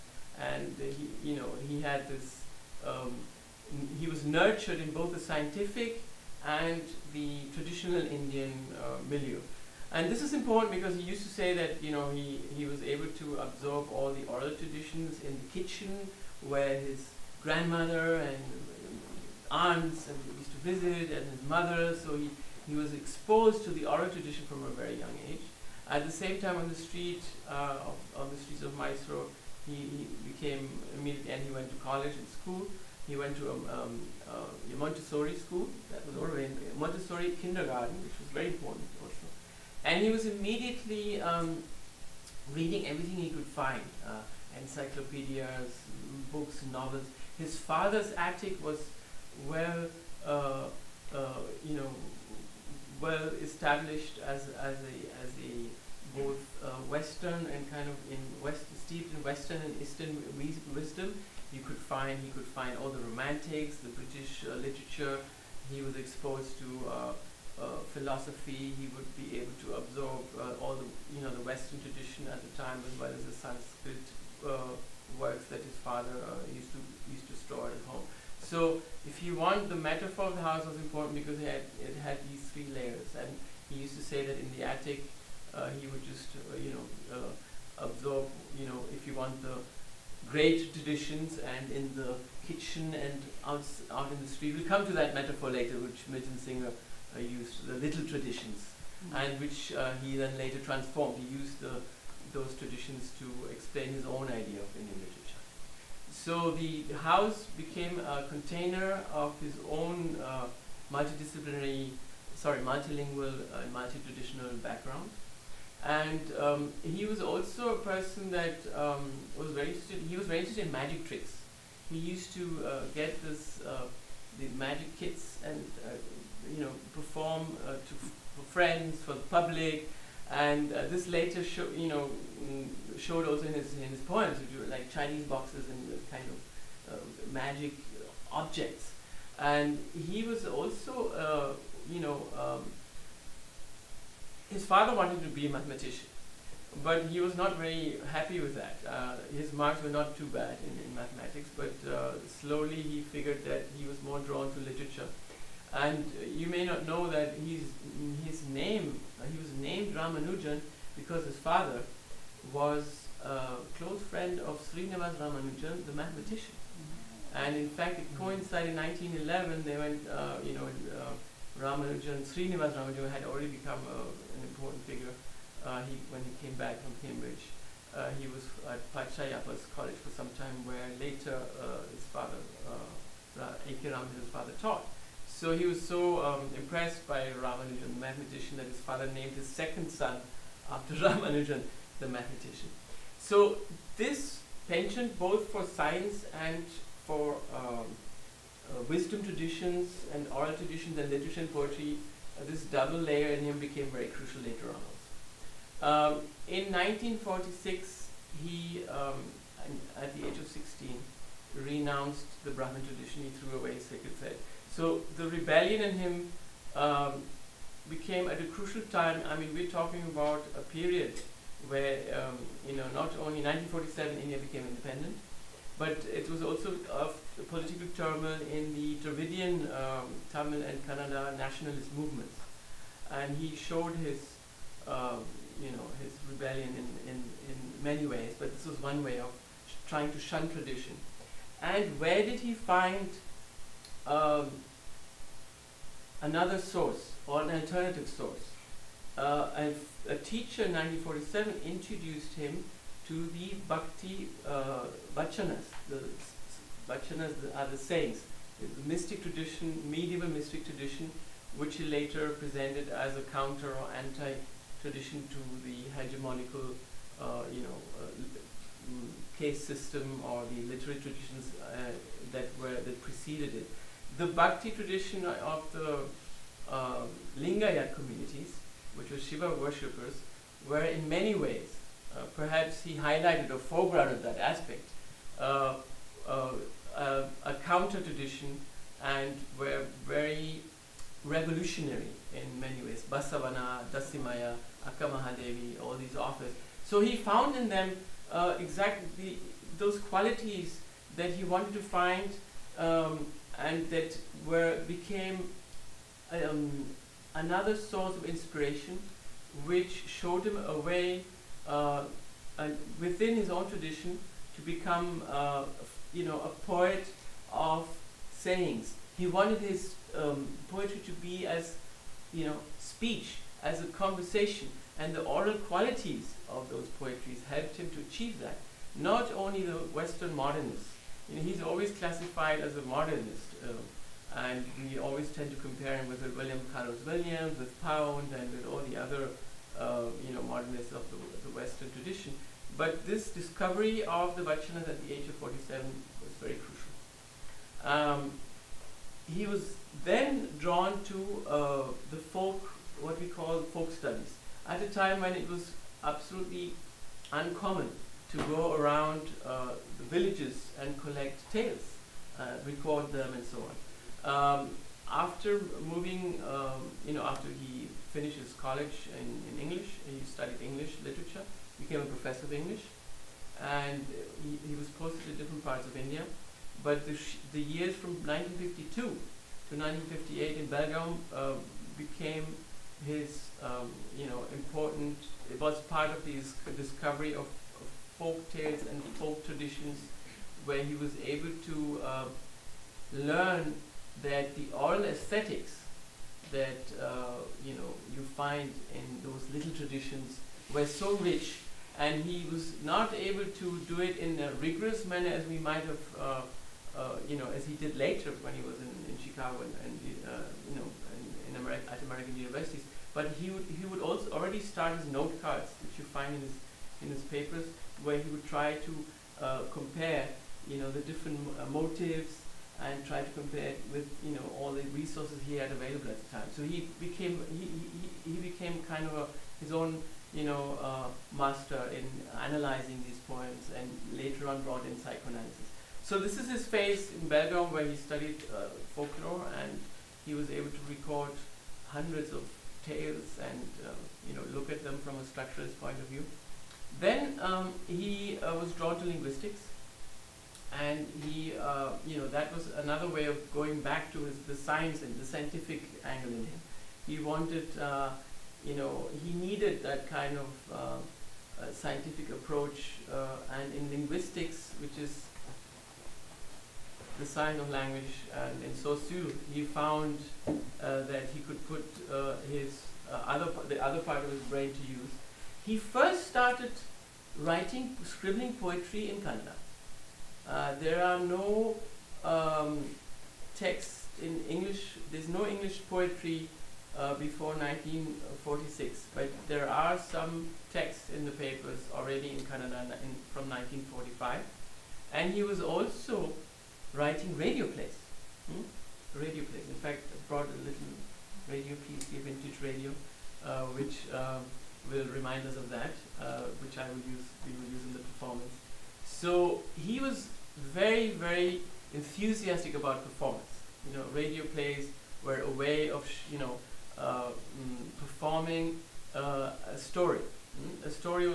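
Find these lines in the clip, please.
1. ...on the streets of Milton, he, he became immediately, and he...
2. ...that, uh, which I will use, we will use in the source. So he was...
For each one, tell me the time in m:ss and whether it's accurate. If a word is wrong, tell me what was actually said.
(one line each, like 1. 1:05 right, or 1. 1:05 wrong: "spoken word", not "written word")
1. 0:28 wrong: "Mysore", not "Milton"
2. 8:25 wrong: "performance", not "source".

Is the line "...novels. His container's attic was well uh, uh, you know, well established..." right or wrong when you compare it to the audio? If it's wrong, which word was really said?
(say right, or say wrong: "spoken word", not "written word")
wrong: "father", not "container".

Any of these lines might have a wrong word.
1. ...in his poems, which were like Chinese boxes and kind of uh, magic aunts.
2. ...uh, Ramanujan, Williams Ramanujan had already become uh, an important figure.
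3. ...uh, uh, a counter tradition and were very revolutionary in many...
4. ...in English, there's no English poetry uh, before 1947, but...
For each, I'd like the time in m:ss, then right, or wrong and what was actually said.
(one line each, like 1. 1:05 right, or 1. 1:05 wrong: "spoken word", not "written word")
1. 2:13 wrong: "objects", not "aunts"
2. 2:50 wrong: "Srinivas", not "Williams"
3. 4:46 right
4. 8:04 wrong: "1946", not "1947".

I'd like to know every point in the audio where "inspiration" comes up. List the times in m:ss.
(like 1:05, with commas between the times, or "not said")
5:08.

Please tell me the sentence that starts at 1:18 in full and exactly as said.
So if you want, the metaphor of the house was important because it had, it had these three layers.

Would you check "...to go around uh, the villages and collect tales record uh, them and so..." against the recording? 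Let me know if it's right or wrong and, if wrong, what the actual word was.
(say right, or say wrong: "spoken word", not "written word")
right.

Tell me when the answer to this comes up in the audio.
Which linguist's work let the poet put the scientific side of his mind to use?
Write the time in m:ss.
7:48.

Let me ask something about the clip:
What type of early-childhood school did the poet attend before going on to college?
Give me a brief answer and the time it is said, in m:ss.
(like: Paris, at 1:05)
Montessori kindergarten, at 0:36.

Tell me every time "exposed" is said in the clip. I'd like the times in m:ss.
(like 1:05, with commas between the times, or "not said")
0:22, 1:05.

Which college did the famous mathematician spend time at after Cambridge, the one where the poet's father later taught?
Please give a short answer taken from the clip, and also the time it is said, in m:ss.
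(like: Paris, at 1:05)
Pachaiyappa's college, at 2:58.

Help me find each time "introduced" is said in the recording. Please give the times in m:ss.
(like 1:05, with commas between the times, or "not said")
4:11.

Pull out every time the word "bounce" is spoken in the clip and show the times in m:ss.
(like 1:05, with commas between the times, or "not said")
not said.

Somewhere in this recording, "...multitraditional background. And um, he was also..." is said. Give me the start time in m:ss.
1:53.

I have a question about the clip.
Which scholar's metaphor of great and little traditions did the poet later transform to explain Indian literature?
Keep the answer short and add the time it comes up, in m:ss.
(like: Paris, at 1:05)
Milton Singer, at 1:36.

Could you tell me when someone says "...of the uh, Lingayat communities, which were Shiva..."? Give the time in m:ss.
4:35.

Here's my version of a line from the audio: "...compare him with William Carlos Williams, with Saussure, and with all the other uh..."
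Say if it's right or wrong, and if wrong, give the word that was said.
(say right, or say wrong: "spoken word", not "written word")
wrong: "Pound", not "Saussure".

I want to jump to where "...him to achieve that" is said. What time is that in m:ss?
5:27.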